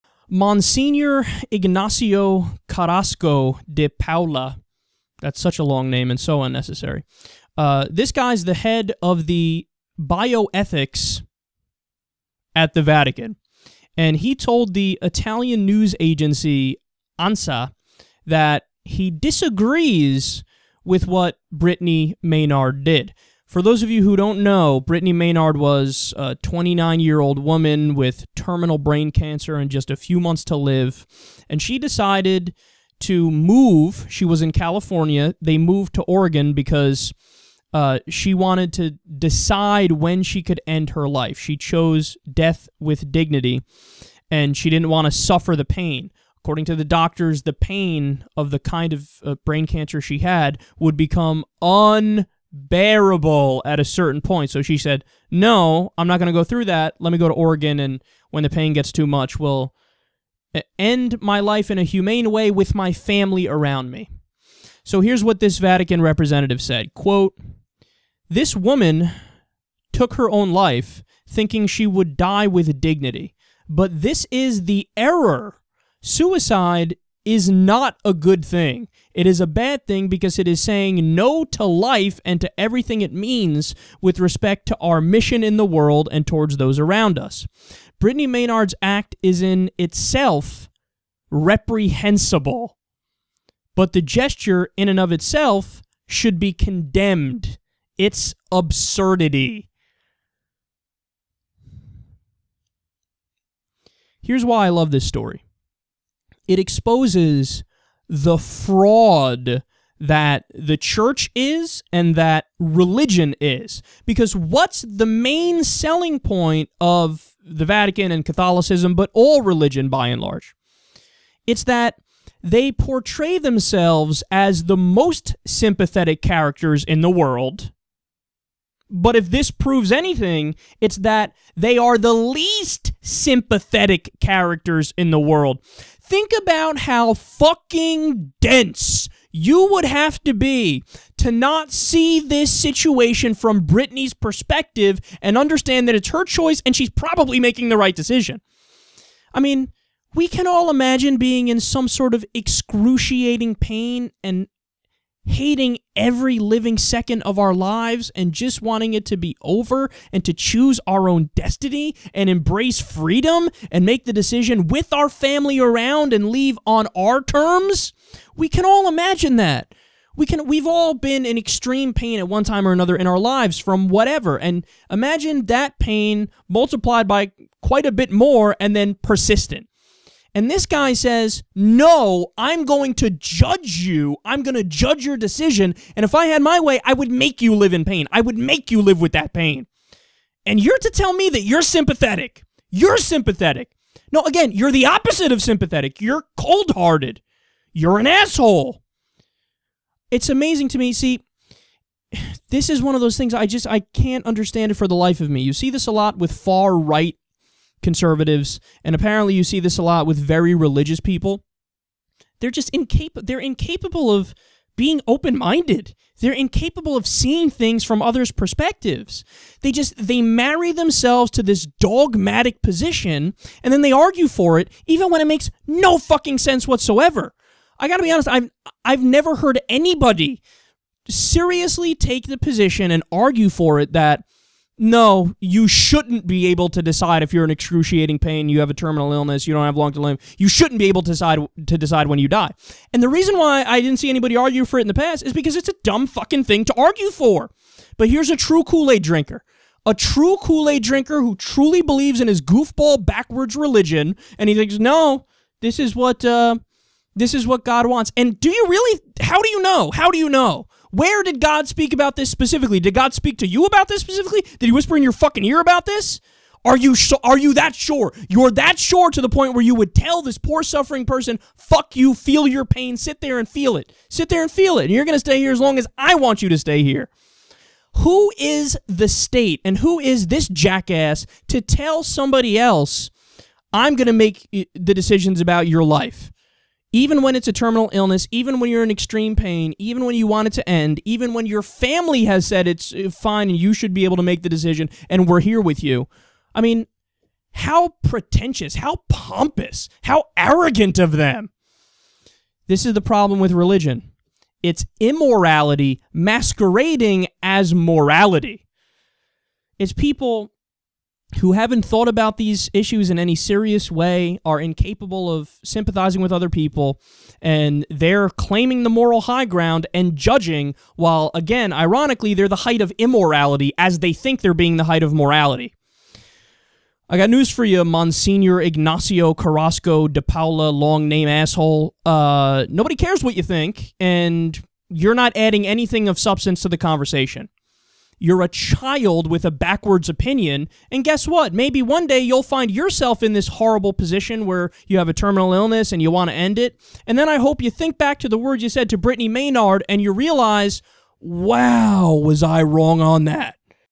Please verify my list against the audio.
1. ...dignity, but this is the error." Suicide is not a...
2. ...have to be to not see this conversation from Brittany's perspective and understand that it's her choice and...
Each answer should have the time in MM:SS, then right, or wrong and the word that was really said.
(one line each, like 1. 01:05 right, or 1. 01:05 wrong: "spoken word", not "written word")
1. 01:12 right
2. 02:19 wrong: "situation", not "conversation".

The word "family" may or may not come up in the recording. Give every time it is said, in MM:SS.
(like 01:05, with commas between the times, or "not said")
01:02, 02:45, 04:51.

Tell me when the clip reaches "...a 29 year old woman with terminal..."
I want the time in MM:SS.
00:26.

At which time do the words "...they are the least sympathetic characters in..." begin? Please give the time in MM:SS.
02:11.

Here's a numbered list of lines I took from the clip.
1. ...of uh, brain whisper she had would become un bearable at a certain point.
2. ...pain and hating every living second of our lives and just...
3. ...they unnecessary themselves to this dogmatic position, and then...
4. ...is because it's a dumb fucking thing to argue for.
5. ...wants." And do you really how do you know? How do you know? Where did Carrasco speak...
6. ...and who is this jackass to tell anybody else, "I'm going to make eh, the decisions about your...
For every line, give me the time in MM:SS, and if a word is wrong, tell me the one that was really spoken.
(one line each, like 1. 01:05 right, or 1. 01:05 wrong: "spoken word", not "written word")
1. 00:48 wrong: "cancer", not "whisper"
2. 02:33 right
3. 03:39 wrong: "marry", not "unnecessary"
4. 04:05 right
5. 04:17 wrong: "God", not "Carrasco"
6. 04:39 wrong: "somebody", not "anybody".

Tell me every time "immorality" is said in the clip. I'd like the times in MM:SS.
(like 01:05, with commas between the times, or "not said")
05:04, 05:22.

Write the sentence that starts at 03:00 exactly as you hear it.
And this guy says, No, I'm going to judge you.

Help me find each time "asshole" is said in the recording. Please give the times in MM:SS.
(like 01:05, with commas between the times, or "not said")
03:18, 05:31.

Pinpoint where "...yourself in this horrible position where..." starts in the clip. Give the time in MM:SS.
05:42.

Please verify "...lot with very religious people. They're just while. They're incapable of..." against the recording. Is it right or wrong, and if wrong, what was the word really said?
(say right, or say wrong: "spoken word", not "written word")
wrong: "incapable", not "while".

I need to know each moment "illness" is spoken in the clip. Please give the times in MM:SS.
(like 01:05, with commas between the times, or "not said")
03:59, 04:47, 05:45.